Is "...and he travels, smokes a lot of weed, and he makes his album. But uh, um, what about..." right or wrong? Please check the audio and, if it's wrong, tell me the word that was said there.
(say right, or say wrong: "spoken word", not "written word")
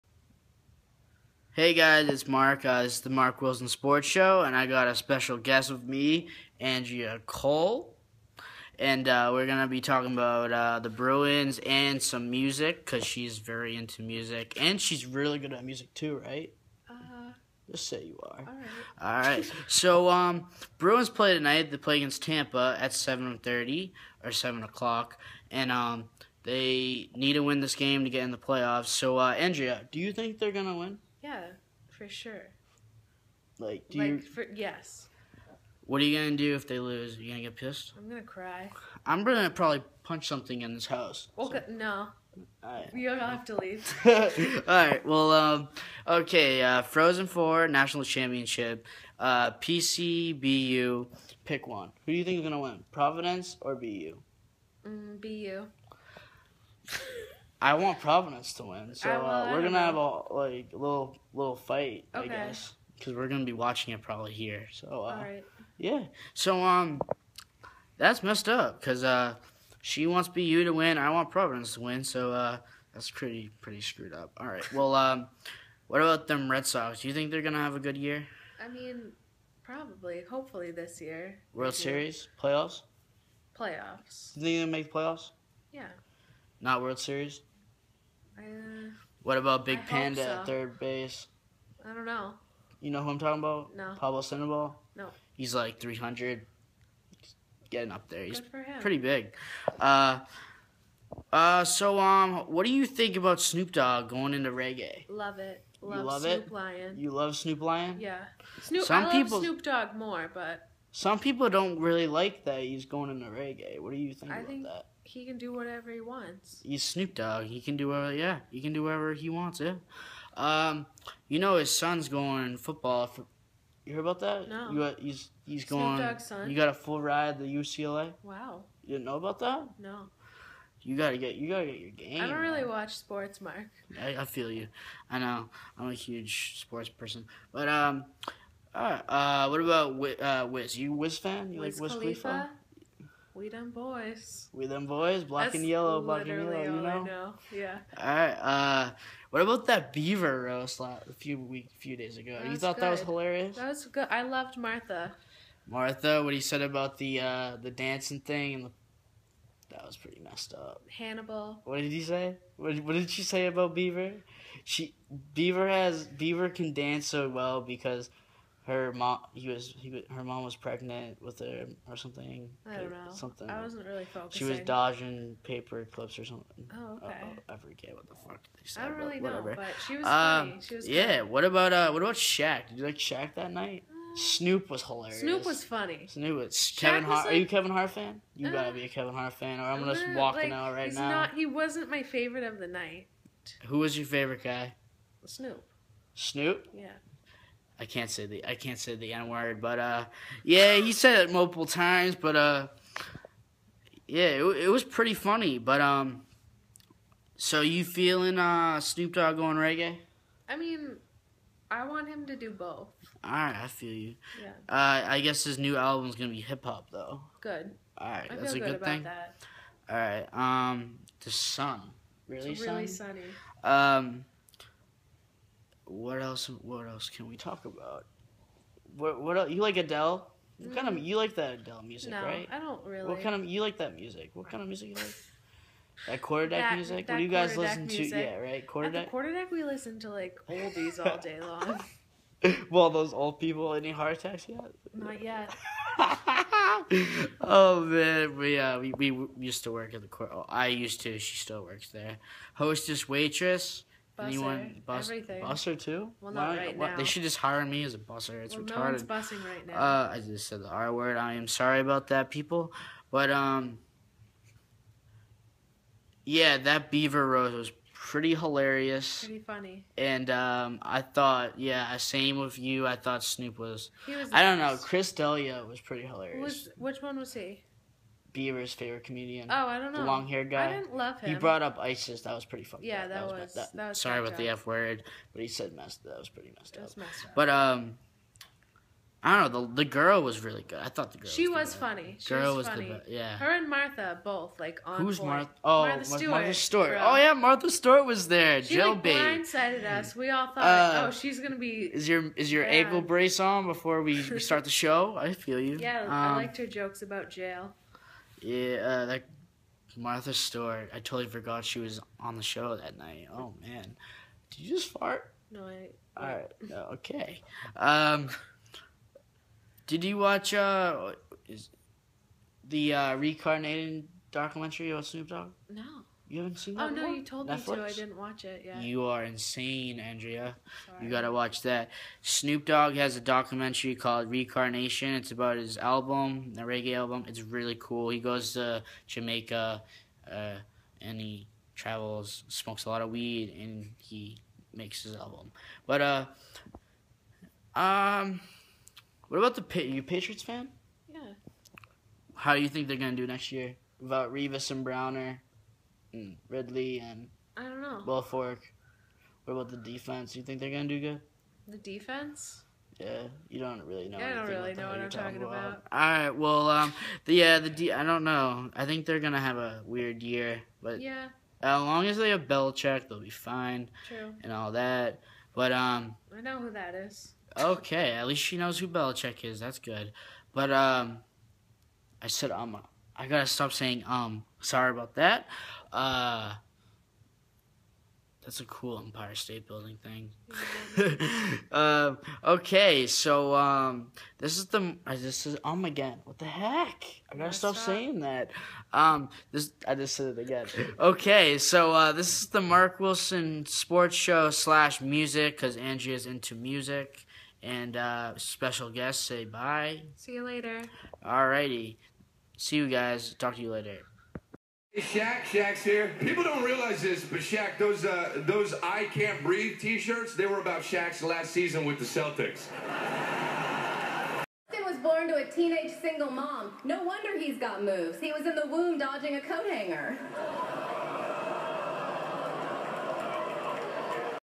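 right.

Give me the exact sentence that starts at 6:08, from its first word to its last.
I think they're gonna have a weird year, but yeah, as long as they have Belichick, they'll be fine.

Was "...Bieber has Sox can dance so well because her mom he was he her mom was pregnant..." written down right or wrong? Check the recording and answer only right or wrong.
wrong.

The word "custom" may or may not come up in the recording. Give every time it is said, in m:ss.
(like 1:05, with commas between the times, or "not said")
not said.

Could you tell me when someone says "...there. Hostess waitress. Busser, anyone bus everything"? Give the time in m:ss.
4:11.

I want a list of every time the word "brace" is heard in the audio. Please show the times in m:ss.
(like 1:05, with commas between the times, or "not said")
5:03.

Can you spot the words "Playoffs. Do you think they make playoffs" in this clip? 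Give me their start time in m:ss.
1:23.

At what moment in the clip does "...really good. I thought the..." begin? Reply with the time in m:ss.
4:50.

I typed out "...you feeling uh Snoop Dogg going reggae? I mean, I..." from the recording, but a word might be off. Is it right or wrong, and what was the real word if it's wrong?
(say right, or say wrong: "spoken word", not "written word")
right.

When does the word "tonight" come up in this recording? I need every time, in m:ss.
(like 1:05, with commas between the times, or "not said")
0:21.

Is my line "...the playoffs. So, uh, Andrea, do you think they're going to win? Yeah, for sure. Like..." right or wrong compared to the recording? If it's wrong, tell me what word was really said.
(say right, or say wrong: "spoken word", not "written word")
right.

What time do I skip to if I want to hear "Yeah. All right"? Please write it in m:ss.
2:27.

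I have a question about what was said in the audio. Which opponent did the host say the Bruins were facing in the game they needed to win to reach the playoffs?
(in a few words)
Tampa.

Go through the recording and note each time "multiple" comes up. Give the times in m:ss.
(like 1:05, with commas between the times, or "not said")
3:21.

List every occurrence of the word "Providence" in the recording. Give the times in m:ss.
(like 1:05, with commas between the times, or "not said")
0:52, 0:57, 1:11.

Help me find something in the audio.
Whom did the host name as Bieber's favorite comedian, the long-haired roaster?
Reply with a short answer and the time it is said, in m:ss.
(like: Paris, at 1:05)
Chris D'Elia, at 4:34.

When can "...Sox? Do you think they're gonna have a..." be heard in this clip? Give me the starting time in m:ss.
1:16.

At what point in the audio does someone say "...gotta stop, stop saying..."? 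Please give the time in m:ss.
6:37.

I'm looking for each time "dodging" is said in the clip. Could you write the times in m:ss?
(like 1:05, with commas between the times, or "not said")
2:54, 7:08.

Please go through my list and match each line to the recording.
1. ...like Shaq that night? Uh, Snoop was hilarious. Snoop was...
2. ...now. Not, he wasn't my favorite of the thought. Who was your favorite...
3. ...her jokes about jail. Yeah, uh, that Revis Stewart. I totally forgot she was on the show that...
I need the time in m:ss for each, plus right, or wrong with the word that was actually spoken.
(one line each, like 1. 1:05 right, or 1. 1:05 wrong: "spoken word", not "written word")
1. 3:02 right
2. 3:10 wrong: "night", not "thought"
3. 5:06 wrong: "Martha", not "Revis".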